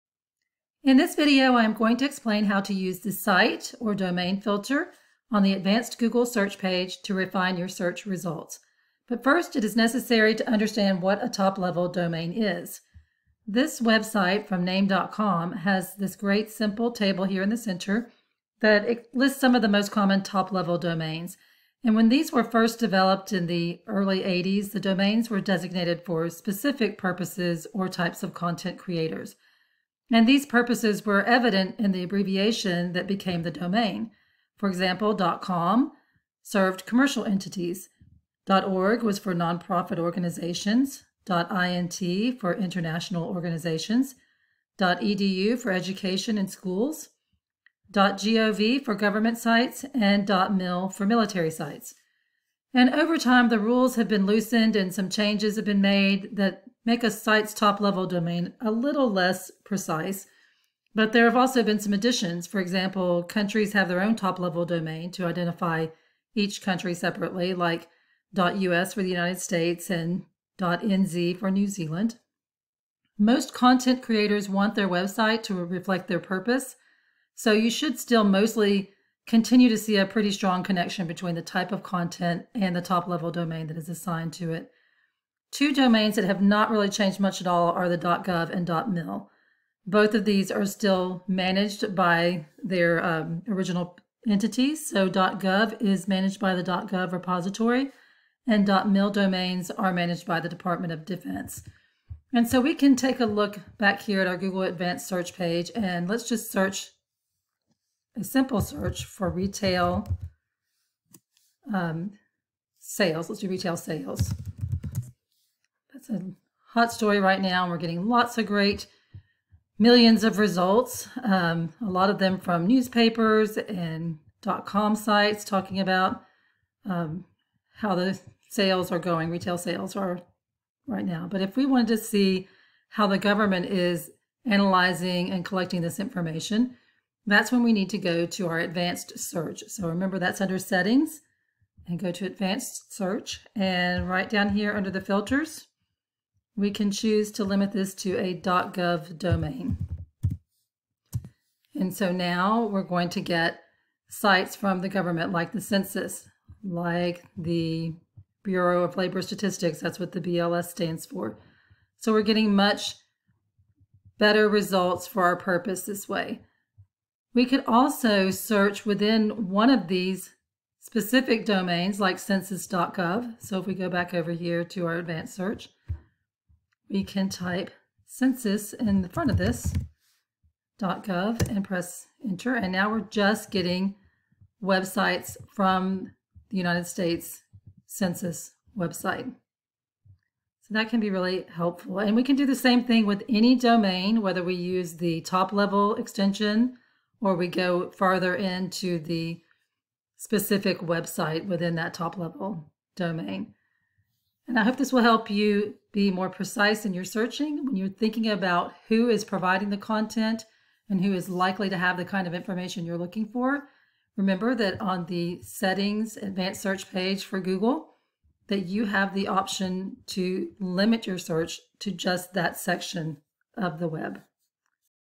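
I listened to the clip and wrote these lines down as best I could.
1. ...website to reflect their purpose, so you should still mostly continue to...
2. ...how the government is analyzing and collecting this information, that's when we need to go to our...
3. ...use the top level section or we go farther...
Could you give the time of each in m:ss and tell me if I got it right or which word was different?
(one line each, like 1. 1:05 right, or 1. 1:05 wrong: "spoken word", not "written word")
1. 1:14 right
2. 2:12 right
3. 3:14 wrong: "extension", not "section".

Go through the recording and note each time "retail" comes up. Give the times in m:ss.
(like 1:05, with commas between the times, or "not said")
1:49, 1:53, 2:09.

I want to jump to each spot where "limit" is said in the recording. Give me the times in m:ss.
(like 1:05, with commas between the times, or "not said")
2:27, 3:40.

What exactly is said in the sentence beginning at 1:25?
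Two domains that have not really changed much at all are the .gov and .mil.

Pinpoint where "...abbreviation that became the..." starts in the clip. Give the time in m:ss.
0:32.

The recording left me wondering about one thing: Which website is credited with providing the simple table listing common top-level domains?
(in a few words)
name.com.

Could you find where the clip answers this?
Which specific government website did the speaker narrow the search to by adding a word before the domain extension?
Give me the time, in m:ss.
2:52.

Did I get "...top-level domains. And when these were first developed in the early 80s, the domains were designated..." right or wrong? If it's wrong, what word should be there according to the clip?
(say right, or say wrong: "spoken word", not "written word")
right.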